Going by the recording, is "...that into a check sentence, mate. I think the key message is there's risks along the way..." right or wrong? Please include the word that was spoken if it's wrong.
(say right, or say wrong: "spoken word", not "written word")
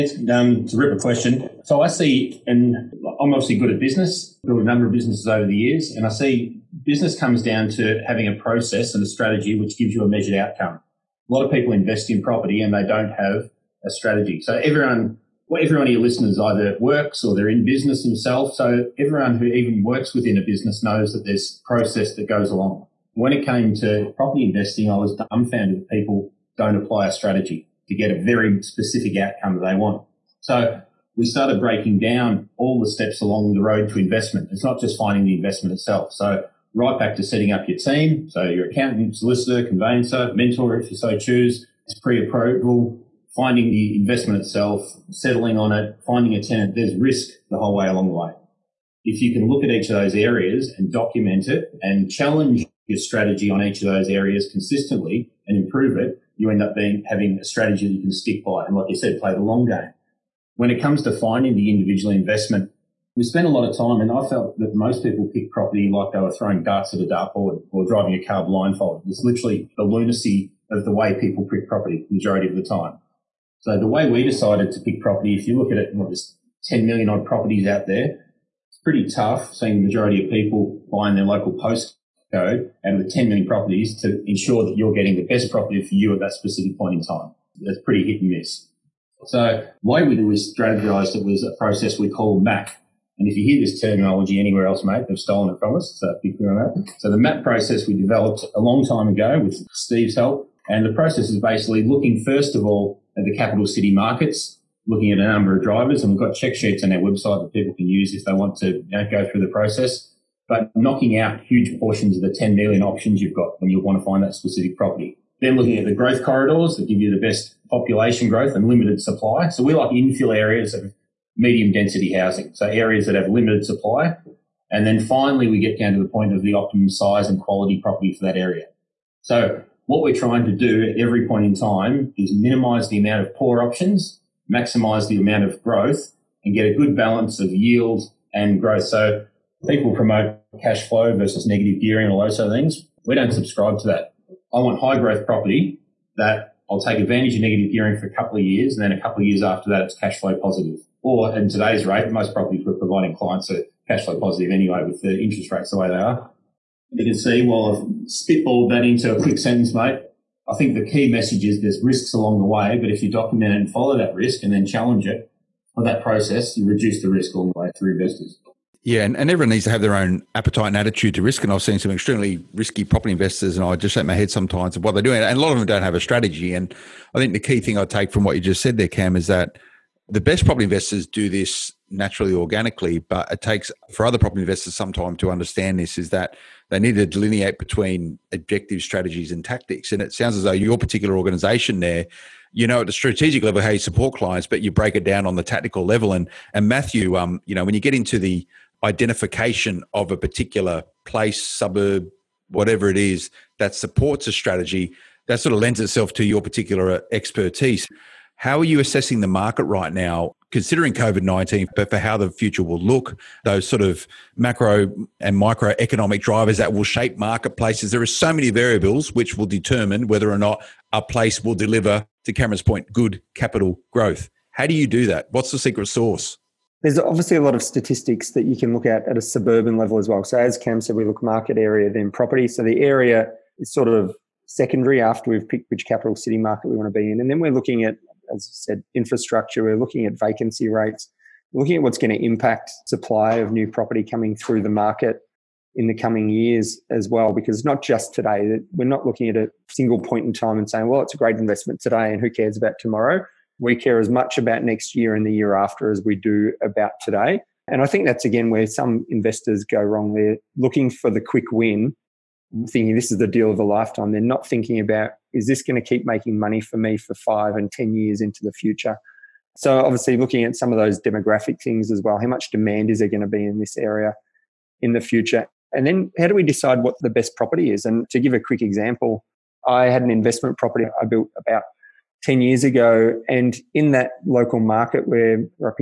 wrong: "quick", not "check".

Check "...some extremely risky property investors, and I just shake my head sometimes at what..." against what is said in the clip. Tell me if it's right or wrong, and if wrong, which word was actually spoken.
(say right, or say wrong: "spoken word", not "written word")
right.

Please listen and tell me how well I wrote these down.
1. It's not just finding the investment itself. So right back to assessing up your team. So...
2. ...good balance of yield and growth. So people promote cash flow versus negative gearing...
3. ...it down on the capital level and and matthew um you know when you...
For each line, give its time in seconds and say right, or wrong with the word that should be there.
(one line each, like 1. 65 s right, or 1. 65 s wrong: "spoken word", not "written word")
1. 34 s wrong: "setting", not "assessing"
2. 136 s right
3. 194 s wrong: "tactical", not "capital".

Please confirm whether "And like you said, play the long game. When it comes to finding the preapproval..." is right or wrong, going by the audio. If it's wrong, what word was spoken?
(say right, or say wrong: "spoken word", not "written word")
wrong: "individual", not "preapproval".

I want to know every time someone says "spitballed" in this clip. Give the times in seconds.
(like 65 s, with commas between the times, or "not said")
158 s.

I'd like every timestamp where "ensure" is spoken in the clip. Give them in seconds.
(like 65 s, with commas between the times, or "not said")
84 s.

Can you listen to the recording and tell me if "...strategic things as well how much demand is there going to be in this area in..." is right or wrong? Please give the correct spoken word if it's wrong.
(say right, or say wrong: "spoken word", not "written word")
wrong: "demographic", not "strategic".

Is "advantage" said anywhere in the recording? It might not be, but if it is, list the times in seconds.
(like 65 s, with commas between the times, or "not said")
146 s.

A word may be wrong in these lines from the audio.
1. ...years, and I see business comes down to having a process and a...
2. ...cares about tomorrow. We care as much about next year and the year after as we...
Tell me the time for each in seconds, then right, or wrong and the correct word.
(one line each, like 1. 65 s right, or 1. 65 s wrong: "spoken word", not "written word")
1. 5 s right
2. 252 s right.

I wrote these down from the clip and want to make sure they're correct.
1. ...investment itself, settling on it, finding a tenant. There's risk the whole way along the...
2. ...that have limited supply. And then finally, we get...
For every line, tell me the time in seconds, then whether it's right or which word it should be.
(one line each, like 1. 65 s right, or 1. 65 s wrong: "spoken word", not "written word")
1. 43 s right
2. 123 s right.